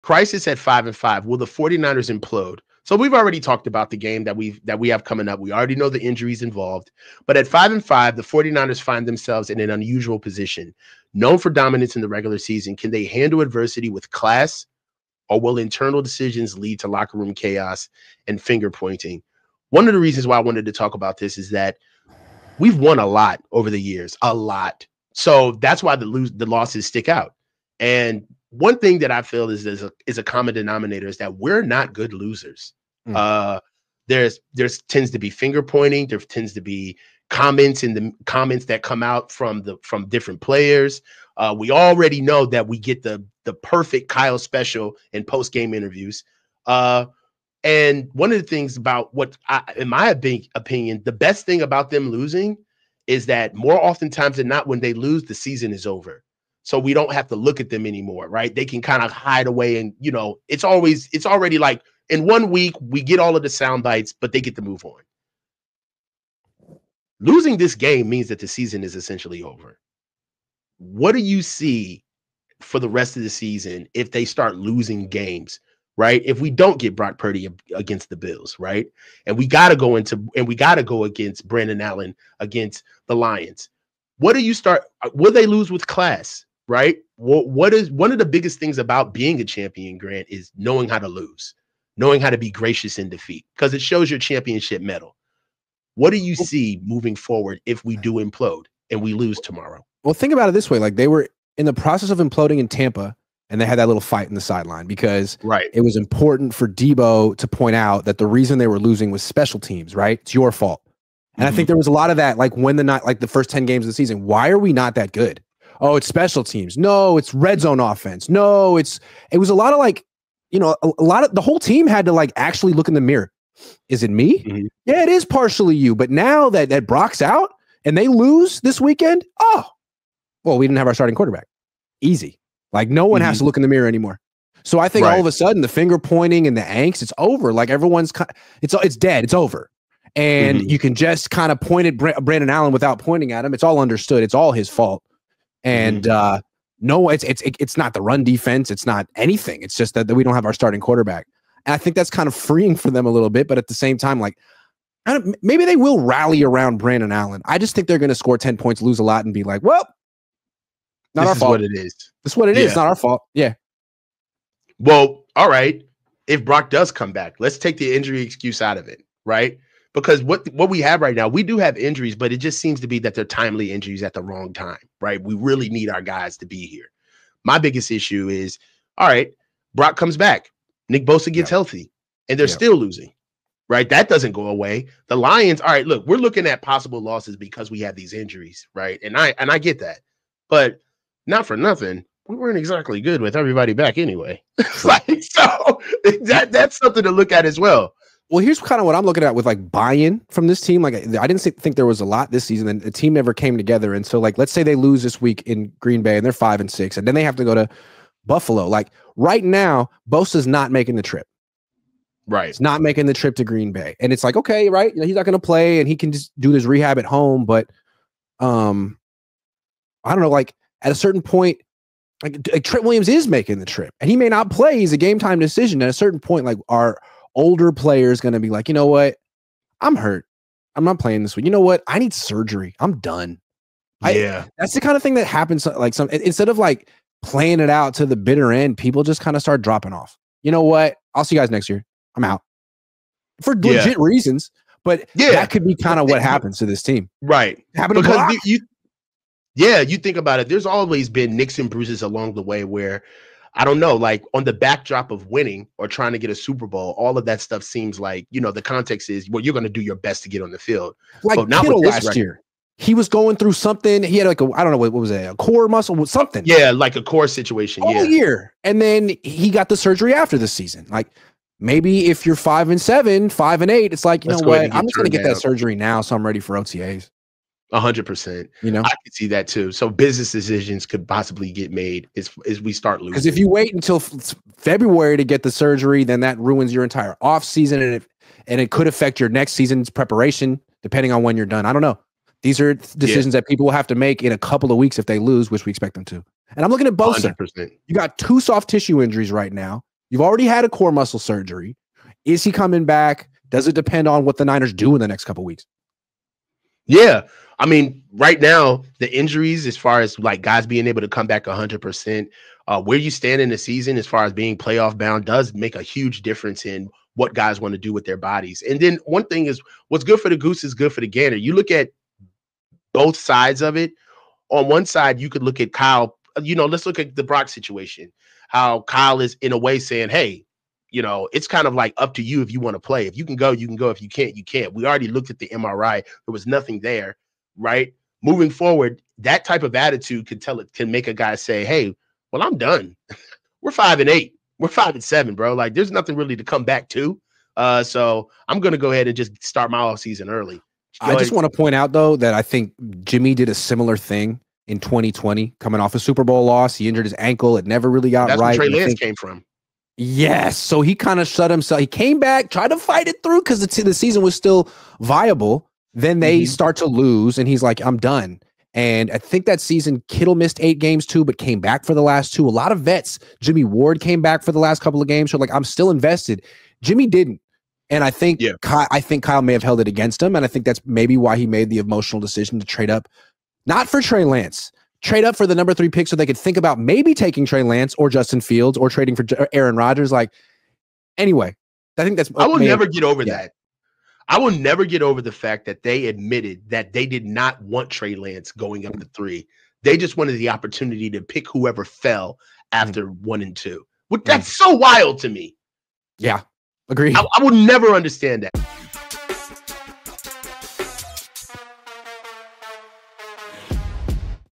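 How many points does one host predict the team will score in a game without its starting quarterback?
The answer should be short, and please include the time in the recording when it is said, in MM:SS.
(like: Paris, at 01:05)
10, at 02:38.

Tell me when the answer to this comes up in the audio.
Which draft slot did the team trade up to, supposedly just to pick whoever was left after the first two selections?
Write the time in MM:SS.
06:25.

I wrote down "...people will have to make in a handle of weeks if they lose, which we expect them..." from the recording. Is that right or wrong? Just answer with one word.
wrong.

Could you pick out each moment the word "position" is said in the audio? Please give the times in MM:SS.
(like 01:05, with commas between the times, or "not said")
00:10.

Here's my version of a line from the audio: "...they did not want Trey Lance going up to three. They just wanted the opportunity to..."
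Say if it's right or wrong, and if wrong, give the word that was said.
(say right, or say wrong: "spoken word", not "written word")
right.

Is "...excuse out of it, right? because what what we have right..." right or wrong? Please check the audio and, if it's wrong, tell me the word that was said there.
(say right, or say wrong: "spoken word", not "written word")
right.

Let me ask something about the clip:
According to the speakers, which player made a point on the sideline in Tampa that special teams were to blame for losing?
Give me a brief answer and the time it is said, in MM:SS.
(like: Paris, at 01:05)
Deebo, at 01:46.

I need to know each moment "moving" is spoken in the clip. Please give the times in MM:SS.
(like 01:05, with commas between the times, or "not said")
01:36, 05:38.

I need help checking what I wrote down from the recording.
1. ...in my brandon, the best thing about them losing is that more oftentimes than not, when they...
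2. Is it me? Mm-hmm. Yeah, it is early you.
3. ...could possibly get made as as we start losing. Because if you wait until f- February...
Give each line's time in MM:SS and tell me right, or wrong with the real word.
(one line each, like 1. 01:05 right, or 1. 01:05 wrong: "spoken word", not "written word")
1. 00:49 wrong: "opinion", not "brandon"
2. 02:03 wrong: "partially", not "early"
3. 04:40 right.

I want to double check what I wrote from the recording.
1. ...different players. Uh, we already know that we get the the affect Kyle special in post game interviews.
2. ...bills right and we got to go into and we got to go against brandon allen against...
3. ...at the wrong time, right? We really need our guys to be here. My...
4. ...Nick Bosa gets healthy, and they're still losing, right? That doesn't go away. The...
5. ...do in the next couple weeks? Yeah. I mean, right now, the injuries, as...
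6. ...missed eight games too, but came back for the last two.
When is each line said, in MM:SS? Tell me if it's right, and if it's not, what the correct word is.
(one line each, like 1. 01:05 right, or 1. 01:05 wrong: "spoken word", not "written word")
1. 00:40 wrong: "perfect", not "affect"
2. 01:18 right
3. 02:54 right
4. 03:00 right
5. 05:04 right
6. 06:10 right.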